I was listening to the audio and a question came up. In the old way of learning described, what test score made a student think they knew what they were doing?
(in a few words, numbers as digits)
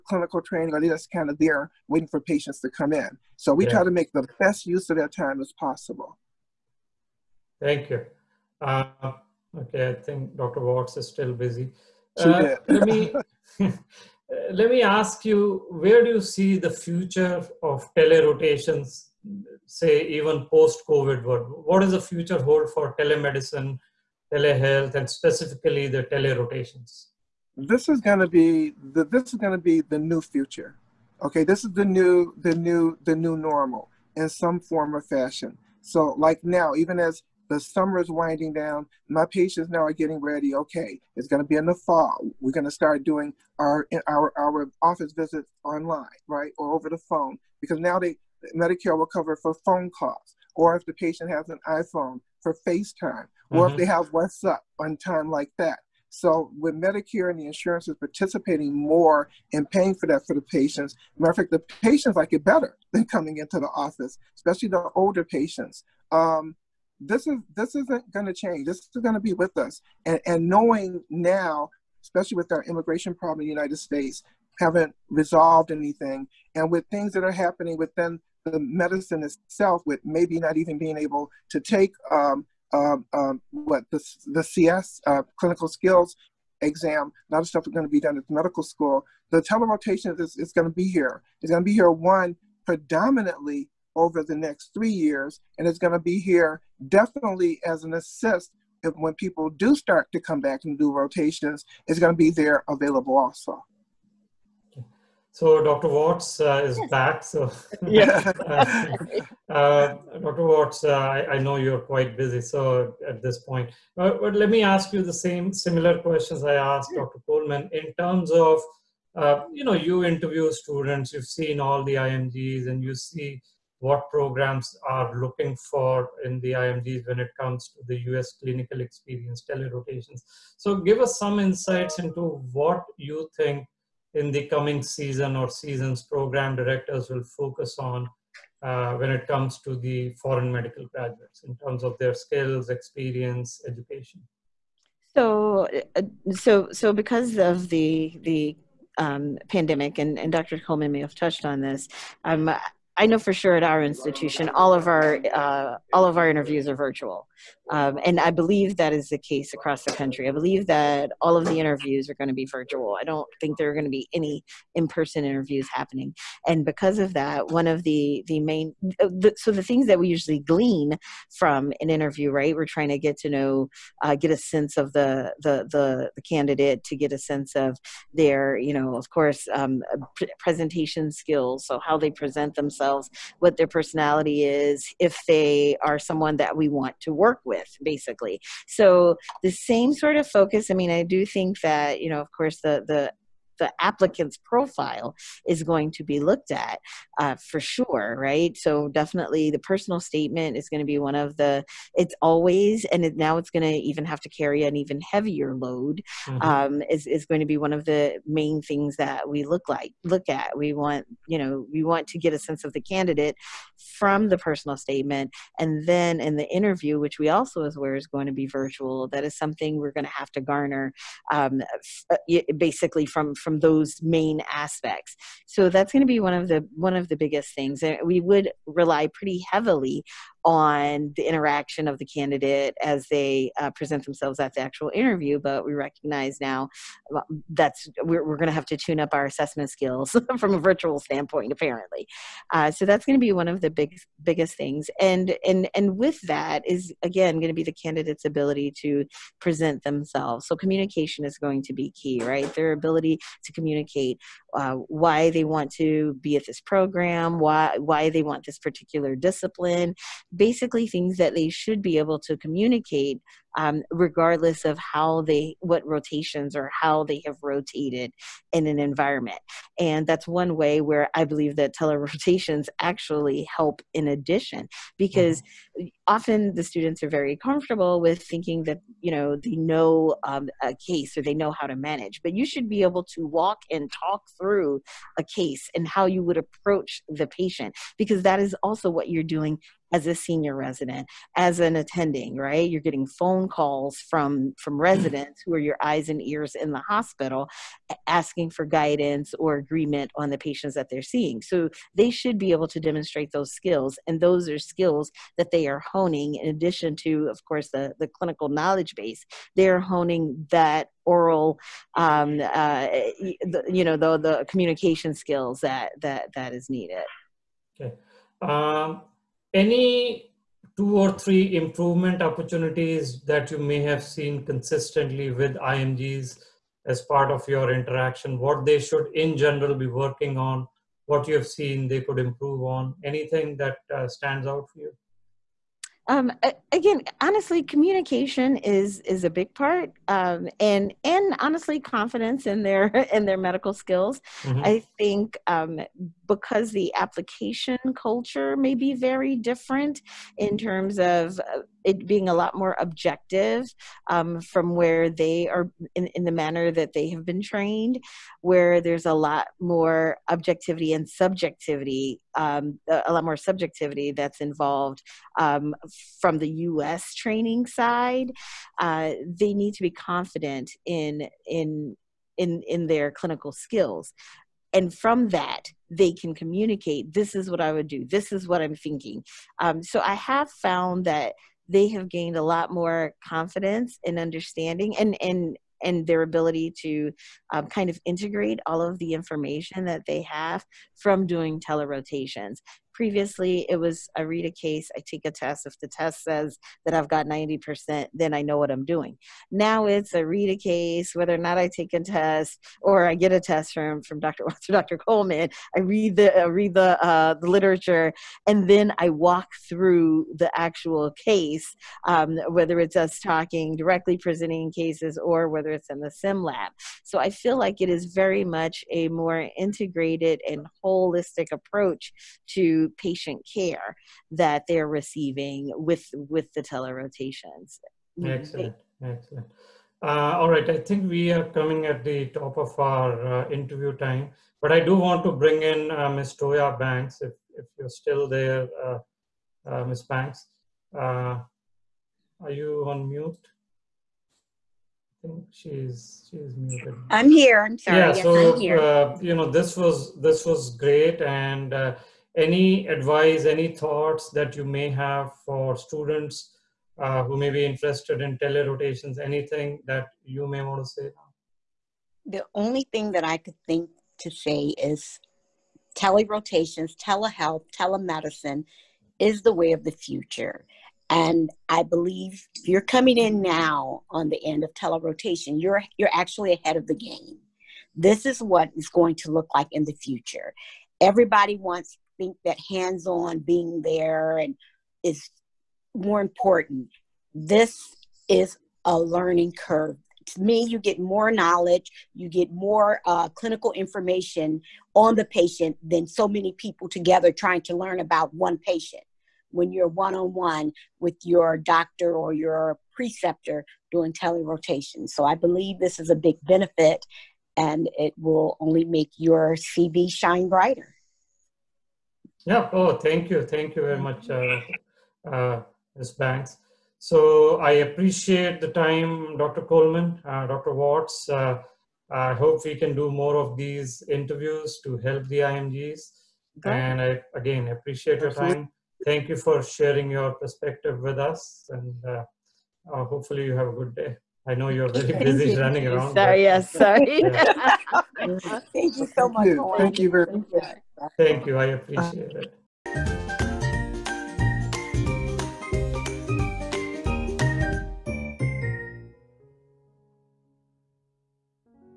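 90%.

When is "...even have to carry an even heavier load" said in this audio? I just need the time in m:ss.
3:23.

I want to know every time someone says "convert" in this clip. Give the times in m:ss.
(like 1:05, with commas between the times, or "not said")
not said.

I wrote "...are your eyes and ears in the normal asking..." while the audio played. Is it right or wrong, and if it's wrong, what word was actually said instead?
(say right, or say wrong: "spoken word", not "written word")
wrong: "hospital", not "normal".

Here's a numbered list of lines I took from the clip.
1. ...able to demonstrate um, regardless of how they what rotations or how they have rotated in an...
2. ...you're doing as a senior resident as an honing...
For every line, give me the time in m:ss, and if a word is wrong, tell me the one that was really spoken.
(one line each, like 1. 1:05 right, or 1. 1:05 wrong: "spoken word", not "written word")
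1. 4:21 wrong: "communicate", not "demonstrate"
2. 4:49 wrong: "attending", not "honing".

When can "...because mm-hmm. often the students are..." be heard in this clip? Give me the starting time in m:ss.
4:34.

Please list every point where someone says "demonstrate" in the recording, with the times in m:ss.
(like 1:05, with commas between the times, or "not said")
5:02.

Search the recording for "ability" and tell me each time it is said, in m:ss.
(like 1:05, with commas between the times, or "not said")
4:08, 4:12, 6:26.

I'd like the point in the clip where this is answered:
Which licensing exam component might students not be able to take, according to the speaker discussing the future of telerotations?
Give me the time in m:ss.
1:25.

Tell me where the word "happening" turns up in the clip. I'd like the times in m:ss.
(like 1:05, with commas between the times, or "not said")
1:17, 2:45.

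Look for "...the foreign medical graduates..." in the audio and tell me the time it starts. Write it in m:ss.
2:19.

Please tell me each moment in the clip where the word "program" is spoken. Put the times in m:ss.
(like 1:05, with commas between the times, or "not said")
2:04, 2:16, 4:16.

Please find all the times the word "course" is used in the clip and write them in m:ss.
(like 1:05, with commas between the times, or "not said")
2:59, 3:12, 5:07.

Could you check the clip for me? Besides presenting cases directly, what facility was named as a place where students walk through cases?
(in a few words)
sim lab.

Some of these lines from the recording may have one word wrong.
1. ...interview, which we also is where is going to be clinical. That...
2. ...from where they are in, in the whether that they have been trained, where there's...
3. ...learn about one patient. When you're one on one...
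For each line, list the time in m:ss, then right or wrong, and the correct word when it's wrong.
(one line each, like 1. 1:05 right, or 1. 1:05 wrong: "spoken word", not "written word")
1. 3:36 wrong: "virtual", not "clinical"
2. 5:54 wrong: "manner", not "whether"
3. 8:17 right.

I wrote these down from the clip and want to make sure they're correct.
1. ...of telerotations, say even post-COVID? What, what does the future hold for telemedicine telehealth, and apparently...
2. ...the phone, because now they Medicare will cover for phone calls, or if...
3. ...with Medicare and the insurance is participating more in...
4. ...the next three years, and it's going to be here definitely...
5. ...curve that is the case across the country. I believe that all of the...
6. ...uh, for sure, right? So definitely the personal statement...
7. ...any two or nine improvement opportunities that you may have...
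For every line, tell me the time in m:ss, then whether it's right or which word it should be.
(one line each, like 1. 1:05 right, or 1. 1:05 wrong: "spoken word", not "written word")
1. 0:17 wrong: "specifically", not "apparently"
2. 0:46 right
3. 0:56 right
4. 1:34 right
5. 2:38 wrong: "believe", not "curve"
6. 3:17 right
7. 5:19 wrong: "three", not "nine".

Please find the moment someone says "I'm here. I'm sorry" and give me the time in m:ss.
7:27.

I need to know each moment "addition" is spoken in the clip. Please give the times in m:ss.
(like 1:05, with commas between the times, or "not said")
4:34, 5:06.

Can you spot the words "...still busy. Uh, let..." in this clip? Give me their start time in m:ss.
0:11.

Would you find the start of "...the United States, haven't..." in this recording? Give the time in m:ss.
1:13.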